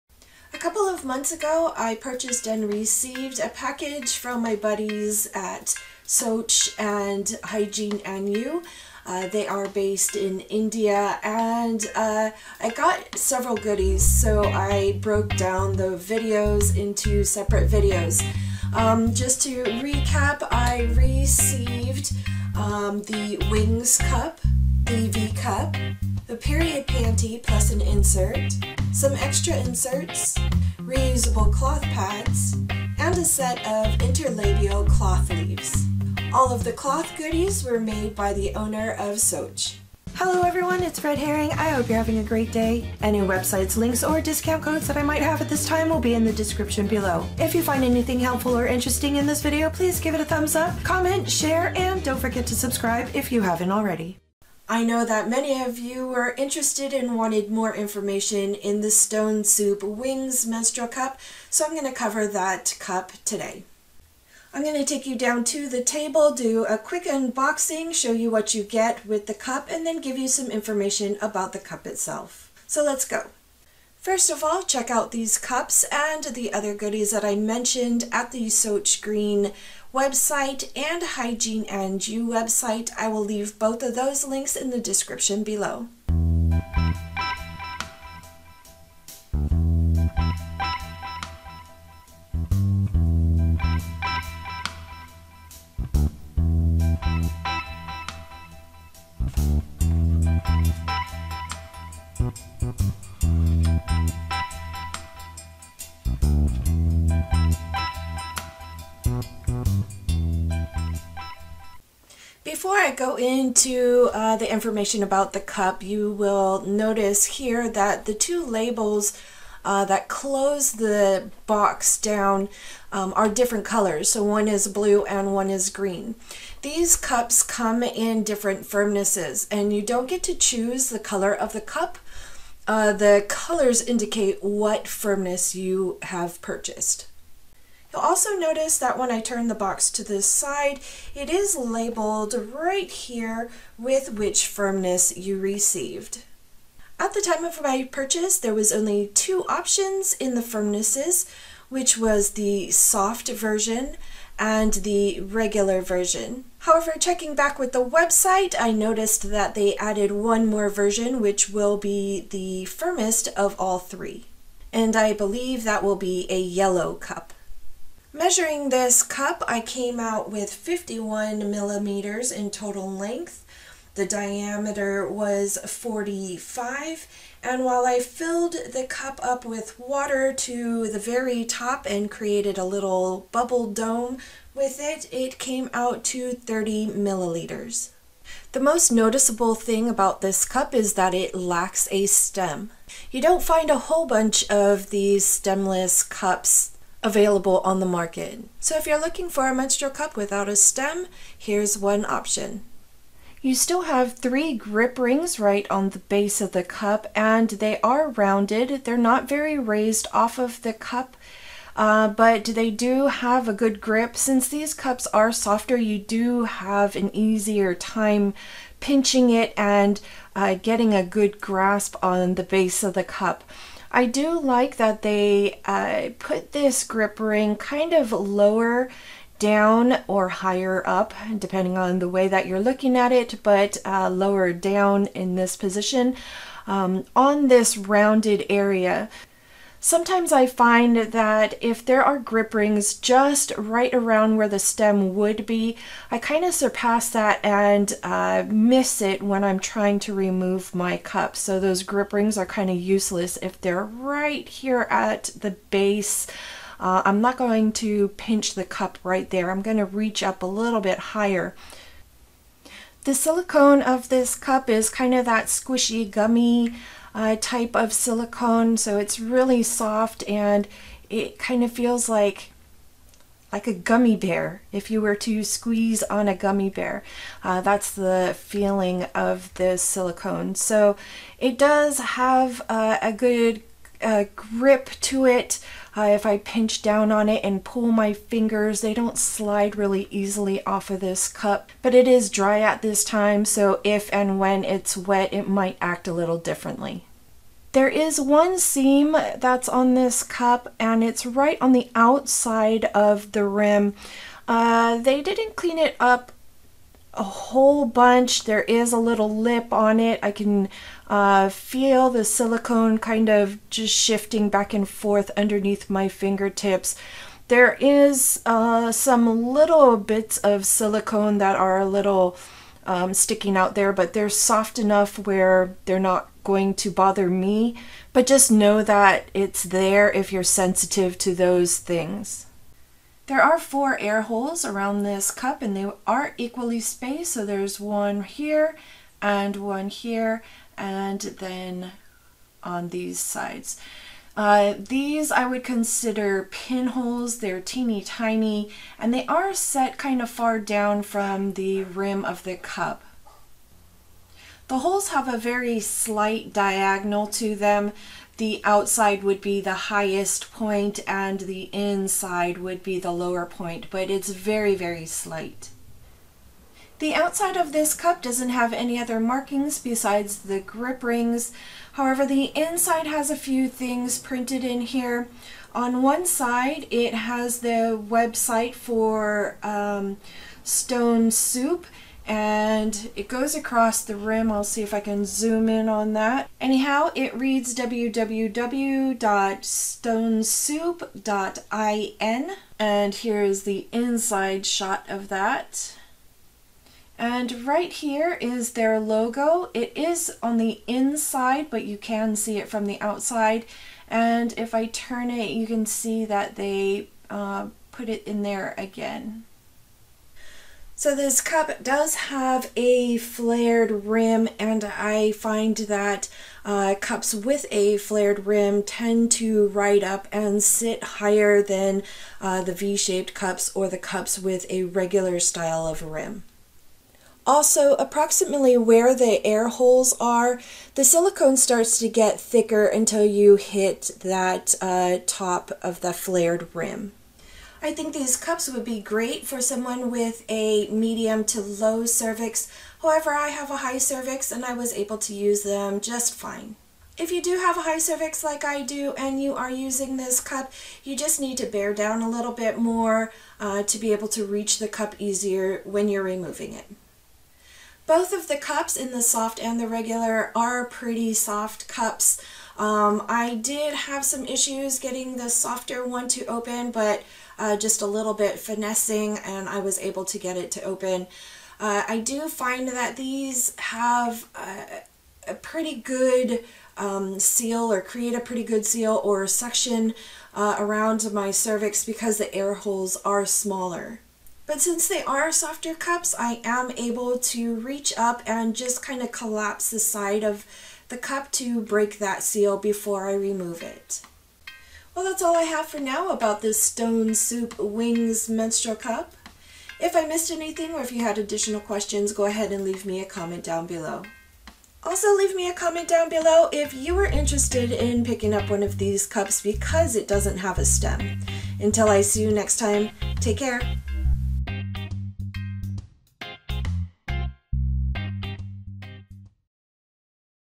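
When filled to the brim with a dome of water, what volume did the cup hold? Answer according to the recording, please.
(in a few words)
30 milliliters.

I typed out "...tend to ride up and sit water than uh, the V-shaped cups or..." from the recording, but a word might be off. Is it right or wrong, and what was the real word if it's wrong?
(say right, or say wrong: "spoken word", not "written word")
wrong: "higher", not "water".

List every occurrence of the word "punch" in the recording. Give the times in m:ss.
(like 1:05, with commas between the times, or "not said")
not said.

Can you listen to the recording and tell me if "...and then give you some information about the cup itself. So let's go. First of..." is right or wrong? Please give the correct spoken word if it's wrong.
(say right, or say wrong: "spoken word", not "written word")
right.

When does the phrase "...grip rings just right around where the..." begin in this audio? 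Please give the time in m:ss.
4:02.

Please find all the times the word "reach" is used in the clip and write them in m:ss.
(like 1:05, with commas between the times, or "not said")
4:19, 7:34, 8:07.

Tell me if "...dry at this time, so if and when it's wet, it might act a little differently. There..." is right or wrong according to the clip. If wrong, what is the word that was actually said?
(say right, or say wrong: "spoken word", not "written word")
right.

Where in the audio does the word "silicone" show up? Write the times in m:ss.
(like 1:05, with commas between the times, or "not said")
4:23, 4:27, 4:39, 5:12, 5:20, 7:11.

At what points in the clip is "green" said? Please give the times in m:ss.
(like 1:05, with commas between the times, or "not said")
1:19, 2:05.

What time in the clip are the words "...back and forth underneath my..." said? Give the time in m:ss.
5:14.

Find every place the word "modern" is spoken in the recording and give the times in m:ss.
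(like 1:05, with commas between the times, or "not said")
not said.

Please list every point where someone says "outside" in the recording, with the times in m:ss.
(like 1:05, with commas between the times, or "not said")
5:01, 5:58, 6:07, 6:43.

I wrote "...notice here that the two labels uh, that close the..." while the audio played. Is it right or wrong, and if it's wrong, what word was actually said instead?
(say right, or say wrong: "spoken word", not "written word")
right.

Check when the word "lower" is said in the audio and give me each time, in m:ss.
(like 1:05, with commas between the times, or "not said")
3:48, 3:54, 6:03.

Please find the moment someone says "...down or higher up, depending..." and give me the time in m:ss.
3:49.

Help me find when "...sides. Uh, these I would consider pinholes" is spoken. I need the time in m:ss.
5:43.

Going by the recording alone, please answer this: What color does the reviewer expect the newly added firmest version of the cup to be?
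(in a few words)
yellow.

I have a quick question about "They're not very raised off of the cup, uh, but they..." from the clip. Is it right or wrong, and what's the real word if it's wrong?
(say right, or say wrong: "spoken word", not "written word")
right.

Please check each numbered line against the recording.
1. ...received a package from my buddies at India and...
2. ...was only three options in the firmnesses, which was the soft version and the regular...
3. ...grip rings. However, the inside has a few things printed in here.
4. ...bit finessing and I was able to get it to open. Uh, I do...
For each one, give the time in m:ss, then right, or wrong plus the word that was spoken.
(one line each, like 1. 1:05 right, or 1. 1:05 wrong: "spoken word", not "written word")
1. 0:02 wrong: "Soch", not "India"
2. 2:28 wrong: "two", not "three"
3. 6:10 right
4. 7:48 right.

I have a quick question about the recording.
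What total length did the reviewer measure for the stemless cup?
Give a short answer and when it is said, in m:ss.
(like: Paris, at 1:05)
51 millimeters, at 2:50.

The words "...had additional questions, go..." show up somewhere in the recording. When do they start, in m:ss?
8:21.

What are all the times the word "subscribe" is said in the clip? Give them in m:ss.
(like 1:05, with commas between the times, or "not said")
0:52.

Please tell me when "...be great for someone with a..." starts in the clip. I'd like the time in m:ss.
7:18.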